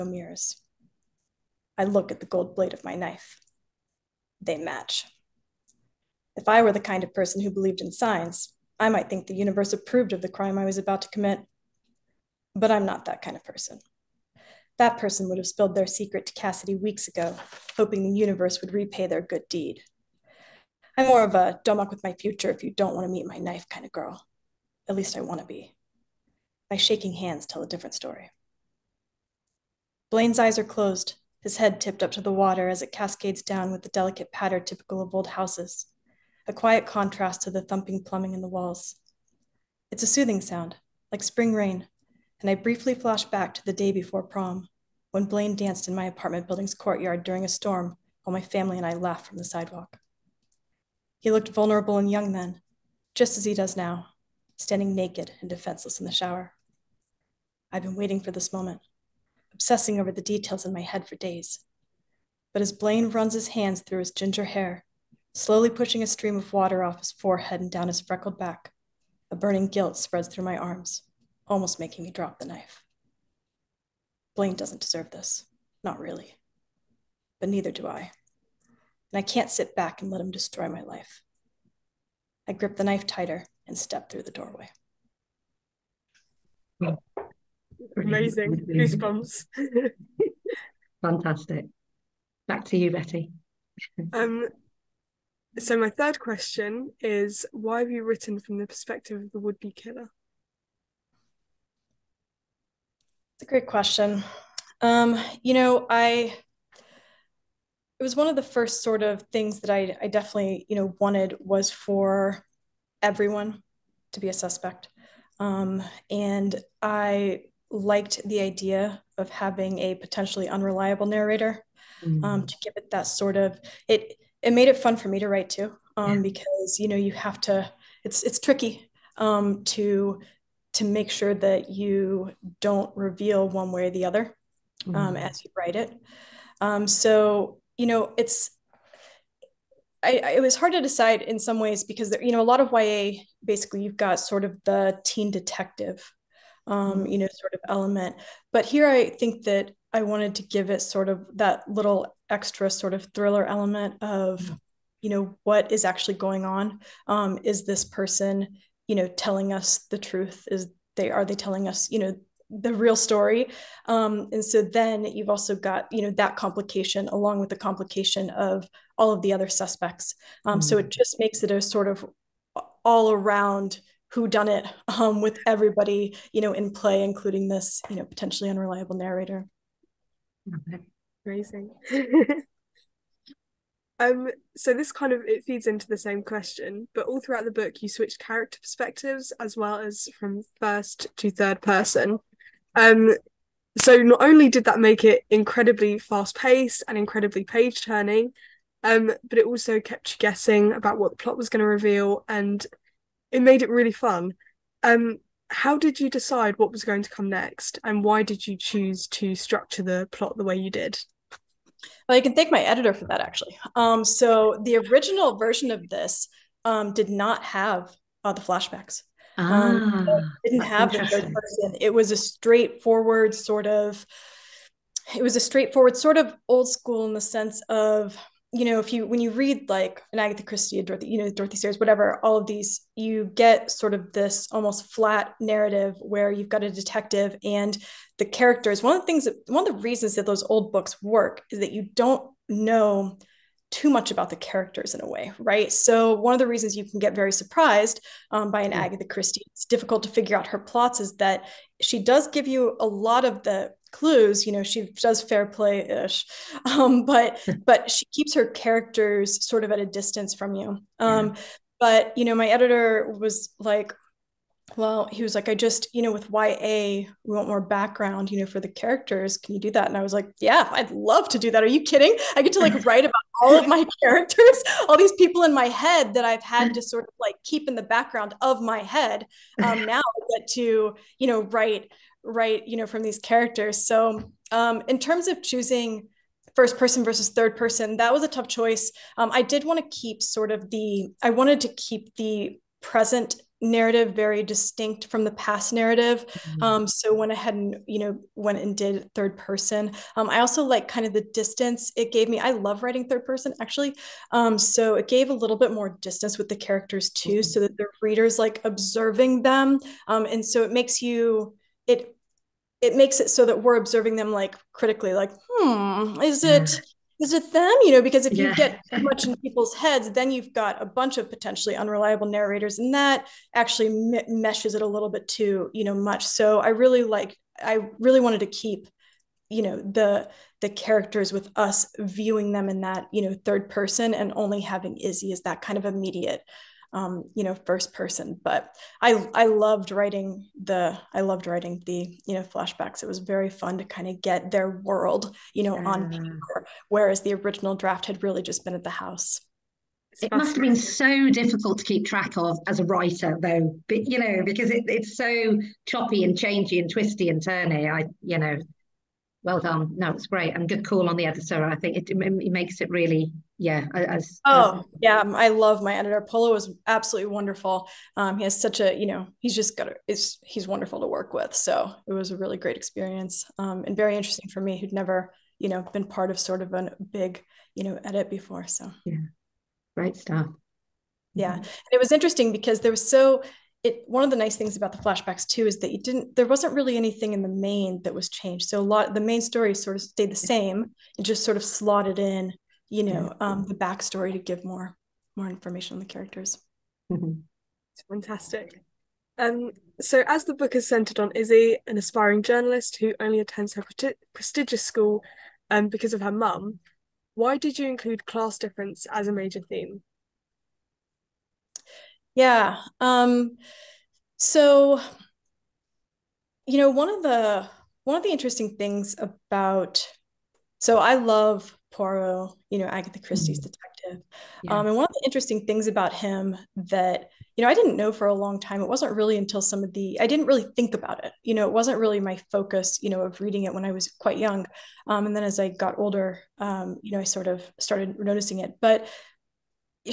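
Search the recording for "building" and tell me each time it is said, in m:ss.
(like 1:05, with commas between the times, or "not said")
0:46.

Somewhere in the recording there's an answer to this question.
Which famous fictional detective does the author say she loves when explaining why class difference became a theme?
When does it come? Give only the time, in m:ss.
7:01.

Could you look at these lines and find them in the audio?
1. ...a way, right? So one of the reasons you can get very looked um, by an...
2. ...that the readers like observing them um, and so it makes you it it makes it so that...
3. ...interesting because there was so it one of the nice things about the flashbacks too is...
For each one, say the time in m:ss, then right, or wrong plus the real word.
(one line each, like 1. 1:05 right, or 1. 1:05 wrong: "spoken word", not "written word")
1. 4:05 wrong: "surprised", not "looked"
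2. 5:07 right
3. 6:22 right.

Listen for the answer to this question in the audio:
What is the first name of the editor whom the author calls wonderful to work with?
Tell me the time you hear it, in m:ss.
6:06.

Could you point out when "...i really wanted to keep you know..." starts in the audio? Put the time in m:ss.
5:27.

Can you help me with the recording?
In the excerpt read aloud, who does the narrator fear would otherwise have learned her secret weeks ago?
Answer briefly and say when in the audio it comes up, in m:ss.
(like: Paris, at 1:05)
Cassidy, at 0:16.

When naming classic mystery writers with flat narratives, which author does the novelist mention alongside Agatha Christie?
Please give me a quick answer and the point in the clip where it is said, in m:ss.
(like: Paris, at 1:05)
Dorothy Sayers, at 3:51.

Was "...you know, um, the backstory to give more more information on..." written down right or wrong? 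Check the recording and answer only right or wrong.
right.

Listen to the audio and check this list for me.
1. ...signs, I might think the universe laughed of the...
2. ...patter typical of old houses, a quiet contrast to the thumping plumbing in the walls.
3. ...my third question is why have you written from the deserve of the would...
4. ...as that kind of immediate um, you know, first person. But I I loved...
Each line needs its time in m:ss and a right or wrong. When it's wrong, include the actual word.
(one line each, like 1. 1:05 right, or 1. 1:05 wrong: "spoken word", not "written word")
1. 0:07 wrong: "approved", not "laughed"
2. 0:34 right
3. 1:35 wrong: "perspective", not "deserve"
4. 5:35 right.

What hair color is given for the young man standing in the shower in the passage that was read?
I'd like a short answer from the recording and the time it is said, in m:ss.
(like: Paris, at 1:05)
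ginger, at 1:04.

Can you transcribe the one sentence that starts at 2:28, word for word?
But here I think that I wanted to give it sort of that little extra sort of thriller element of, mm-hmm.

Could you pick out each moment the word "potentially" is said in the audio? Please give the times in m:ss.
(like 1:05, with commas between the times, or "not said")
1:59, 2:58, 5:21.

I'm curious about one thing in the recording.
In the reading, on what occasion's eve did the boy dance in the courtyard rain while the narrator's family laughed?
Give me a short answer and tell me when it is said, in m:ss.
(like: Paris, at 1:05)
prom, at 0:44.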